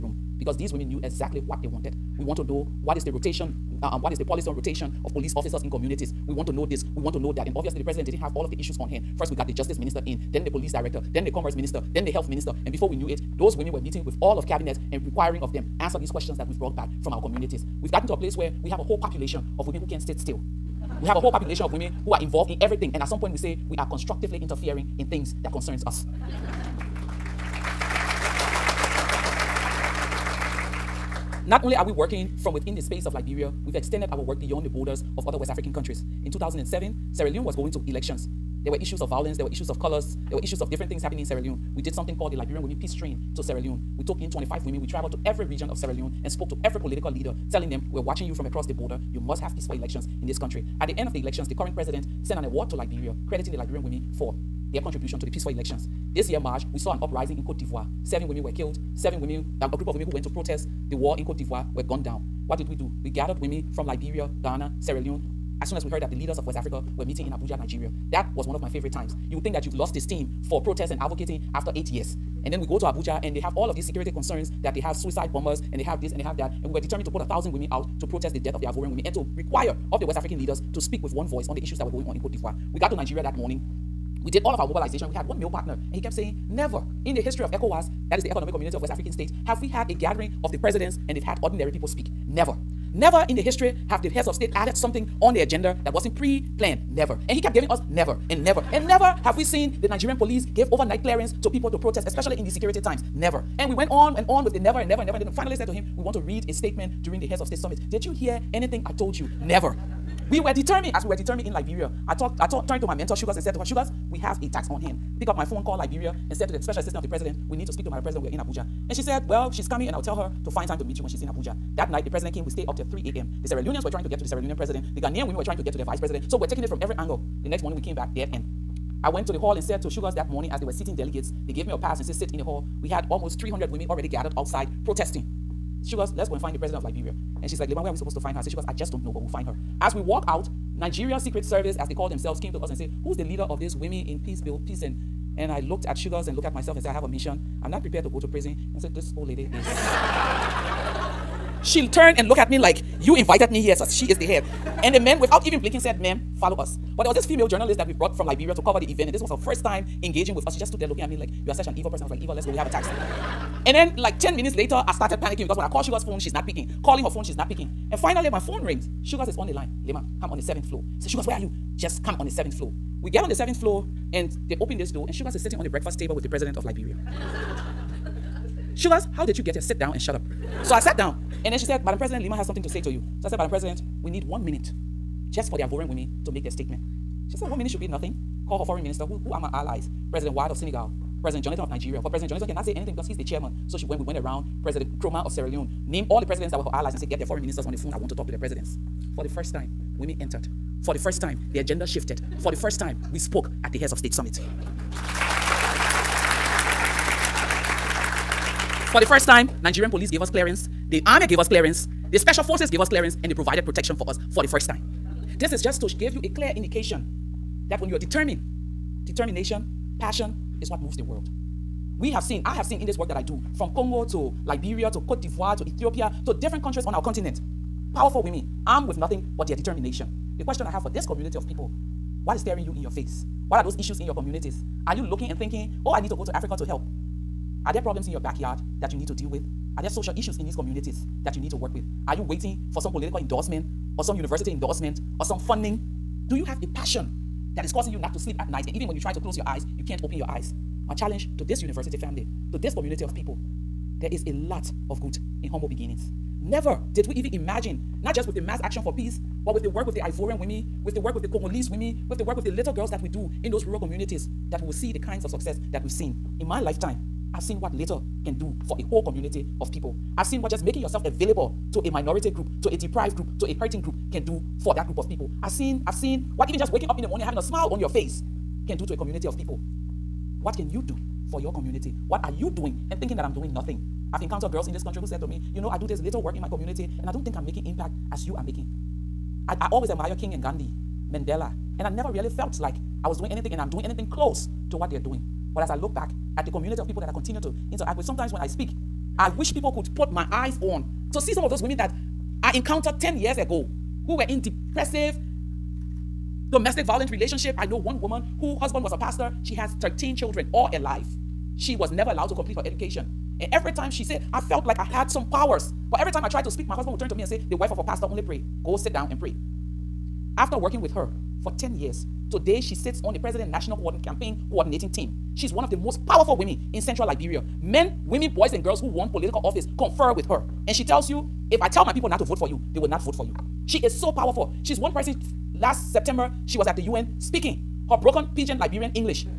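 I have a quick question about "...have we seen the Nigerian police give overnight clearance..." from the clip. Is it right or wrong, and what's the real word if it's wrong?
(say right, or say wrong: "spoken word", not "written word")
right.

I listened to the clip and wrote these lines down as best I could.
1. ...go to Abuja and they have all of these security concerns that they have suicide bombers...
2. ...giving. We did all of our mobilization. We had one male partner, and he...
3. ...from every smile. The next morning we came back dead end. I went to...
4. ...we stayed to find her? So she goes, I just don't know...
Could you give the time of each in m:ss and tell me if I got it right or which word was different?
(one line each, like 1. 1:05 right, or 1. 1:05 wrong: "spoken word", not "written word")
1. 1:12 right
2. 1:23 wrong: "morning", not "giving"
3. 2:06 wrong: "angle", not "smile"
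4. 2:17 wrong: "supposed", not "stayed".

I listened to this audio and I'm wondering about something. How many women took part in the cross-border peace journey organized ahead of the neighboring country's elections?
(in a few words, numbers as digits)
25.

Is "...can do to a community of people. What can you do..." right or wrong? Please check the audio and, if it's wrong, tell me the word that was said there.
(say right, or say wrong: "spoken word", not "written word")
right.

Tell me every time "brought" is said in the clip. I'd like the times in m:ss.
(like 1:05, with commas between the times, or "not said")
0:16, 2:37.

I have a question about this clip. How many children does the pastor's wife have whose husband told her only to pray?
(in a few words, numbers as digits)
13.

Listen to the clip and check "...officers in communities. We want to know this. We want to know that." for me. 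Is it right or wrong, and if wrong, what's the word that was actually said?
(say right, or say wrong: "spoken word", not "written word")
right.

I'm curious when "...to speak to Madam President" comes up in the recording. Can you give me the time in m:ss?
1:57.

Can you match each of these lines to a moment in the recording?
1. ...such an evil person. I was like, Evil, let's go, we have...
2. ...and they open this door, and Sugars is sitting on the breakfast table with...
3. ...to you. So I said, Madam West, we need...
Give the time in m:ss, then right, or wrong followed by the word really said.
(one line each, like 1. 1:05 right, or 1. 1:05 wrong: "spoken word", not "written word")
1. 2:41 right
2. 2:54 right
3. 3:02 wrong: "President", not "West".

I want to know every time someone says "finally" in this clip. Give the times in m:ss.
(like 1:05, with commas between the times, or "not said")
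1:45, 2:47.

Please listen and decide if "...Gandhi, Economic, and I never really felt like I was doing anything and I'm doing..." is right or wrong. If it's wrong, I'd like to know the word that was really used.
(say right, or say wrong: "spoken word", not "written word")
wrong: "Mandela", not "Economic".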